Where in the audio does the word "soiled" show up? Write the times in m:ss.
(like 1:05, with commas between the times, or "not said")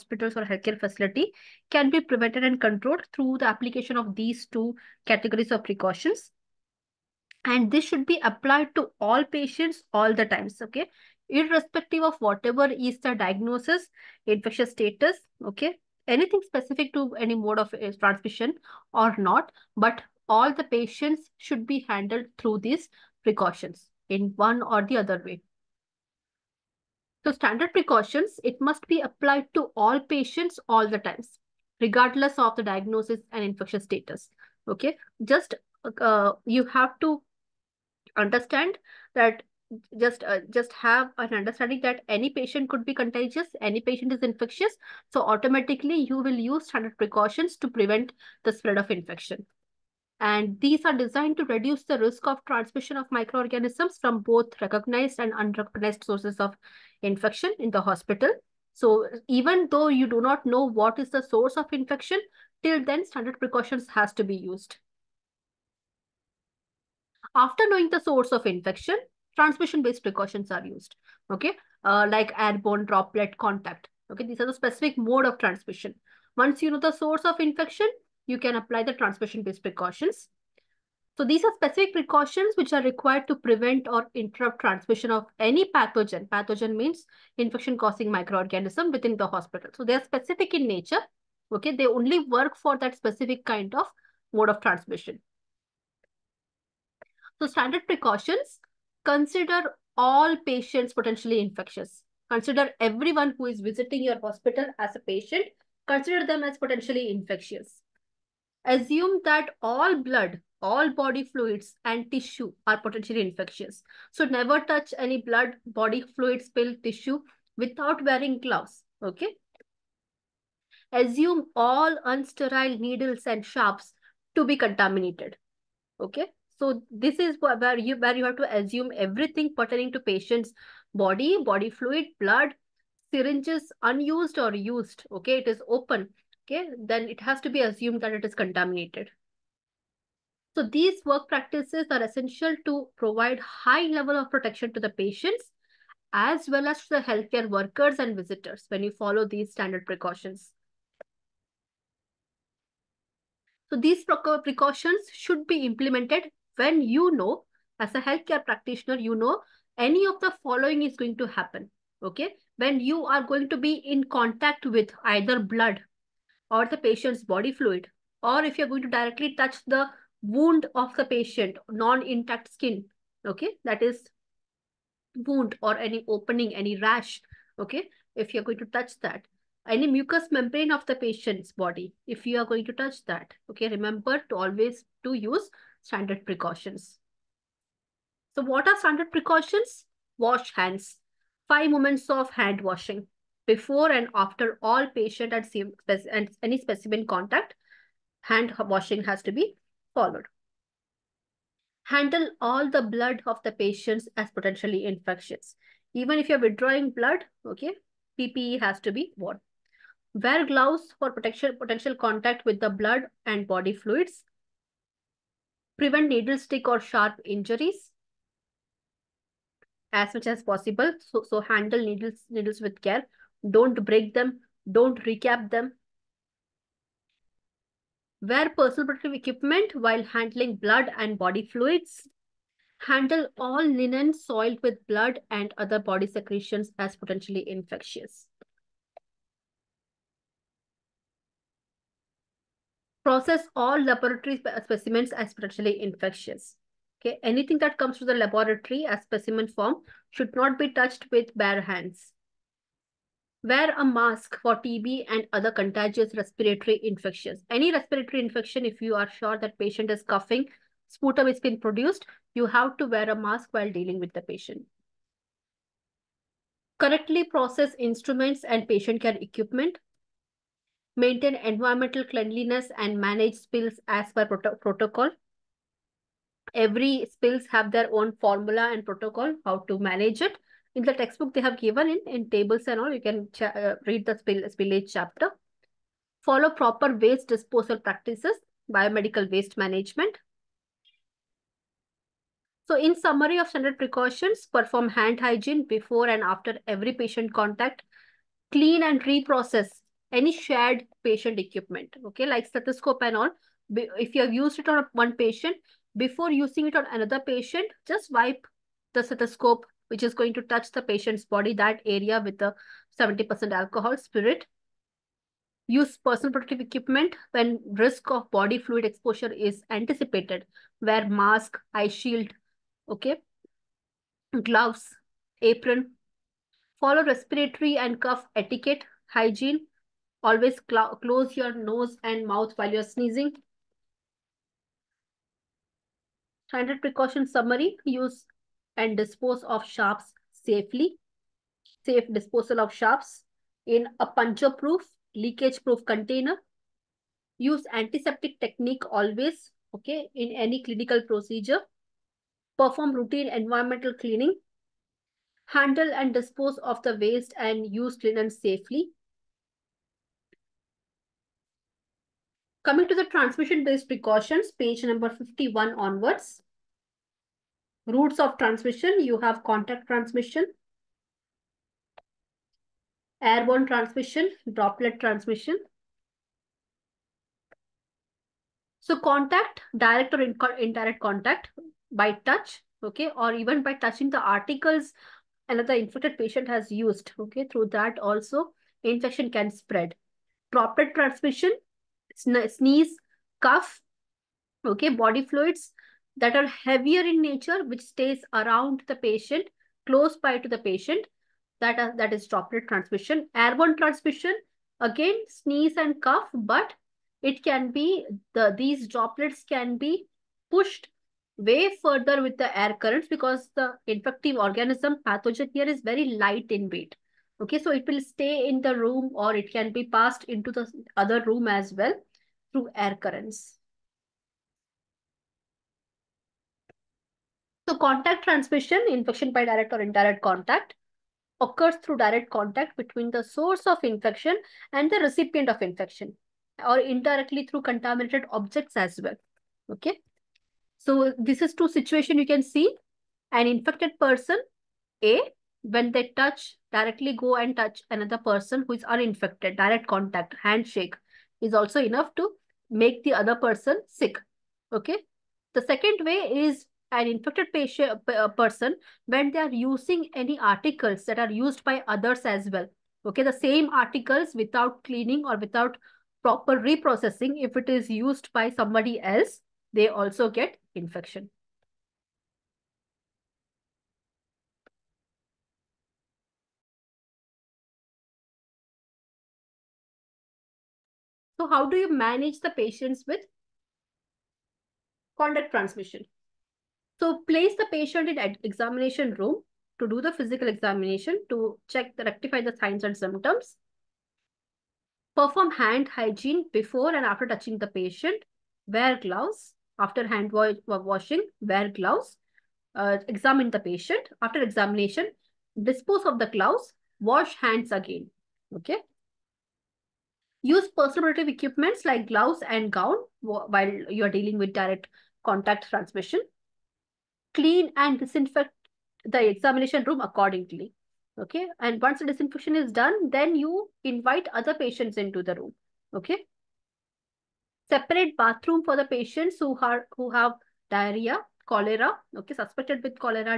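3:54.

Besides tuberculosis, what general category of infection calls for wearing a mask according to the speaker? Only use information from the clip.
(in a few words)
Contagious respiratory infections.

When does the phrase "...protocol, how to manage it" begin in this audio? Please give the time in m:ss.
4:38.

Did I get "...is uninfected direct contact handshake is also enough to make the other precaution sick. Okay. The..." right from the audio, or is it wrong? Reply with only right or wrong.
wrong.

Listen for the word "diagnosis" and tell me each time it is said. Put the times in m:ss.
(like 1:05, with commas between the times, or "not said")
0:13, 0:32.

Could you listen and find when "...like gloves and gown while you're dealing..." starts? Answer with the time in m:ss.
8:31.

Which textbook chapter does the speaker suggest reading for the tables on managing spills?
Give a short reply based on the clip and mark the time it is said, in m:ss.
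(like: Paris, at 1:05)
Spillage chapter, at 4:44.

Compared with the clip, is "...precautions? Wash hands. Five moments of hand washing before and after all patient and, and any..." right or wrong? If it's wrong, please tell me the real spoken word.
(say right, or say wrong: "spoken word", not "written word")
right.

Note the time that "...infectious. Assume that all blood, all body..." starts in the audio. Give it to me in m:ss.
1:47.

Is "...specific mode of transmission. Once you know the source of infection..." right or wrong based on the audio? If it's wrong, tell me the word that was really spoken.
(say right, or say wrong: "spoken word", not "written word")
right.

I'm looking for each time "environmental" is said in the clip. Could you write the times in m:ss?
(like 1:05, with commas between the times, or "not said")
4:31, 5:53.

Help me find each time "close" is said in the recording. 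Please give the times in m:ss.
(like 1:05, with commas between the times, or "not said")
5:30, 6:39.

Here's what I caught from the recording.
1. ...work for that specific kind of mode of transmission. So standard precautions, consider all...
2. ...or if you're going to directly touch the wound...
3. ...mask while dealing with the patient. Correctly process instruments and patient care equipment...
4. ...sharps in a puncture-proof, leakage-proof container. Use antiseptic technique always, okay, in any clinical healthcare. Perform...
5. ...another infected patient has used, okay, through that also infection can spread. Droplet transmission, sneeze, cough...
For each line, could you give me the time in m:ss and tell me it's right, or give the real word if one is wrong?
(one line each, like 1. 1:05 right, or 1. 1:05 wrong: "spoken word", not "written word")
1. 1:32 right
2. 2:48 right
3. 4:23 right
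4. 5:42 wrong: "procedure", not "healthcare"
5. 6:25 right.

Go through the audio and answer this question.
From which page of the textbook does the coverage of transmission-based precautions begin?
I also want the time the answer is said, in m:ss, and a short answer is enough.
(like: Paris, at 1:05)
51, at 6:04.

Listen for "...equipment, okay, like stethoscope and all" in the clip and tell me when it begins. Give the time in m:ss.
5:01.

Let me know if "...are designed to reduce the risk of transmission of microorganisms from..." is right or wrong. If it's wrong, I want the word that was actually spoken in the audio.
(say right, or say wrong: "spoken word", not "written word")
right.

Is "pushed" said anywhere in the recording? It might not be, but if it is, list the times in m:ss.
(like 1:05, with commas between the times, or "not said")
6:50.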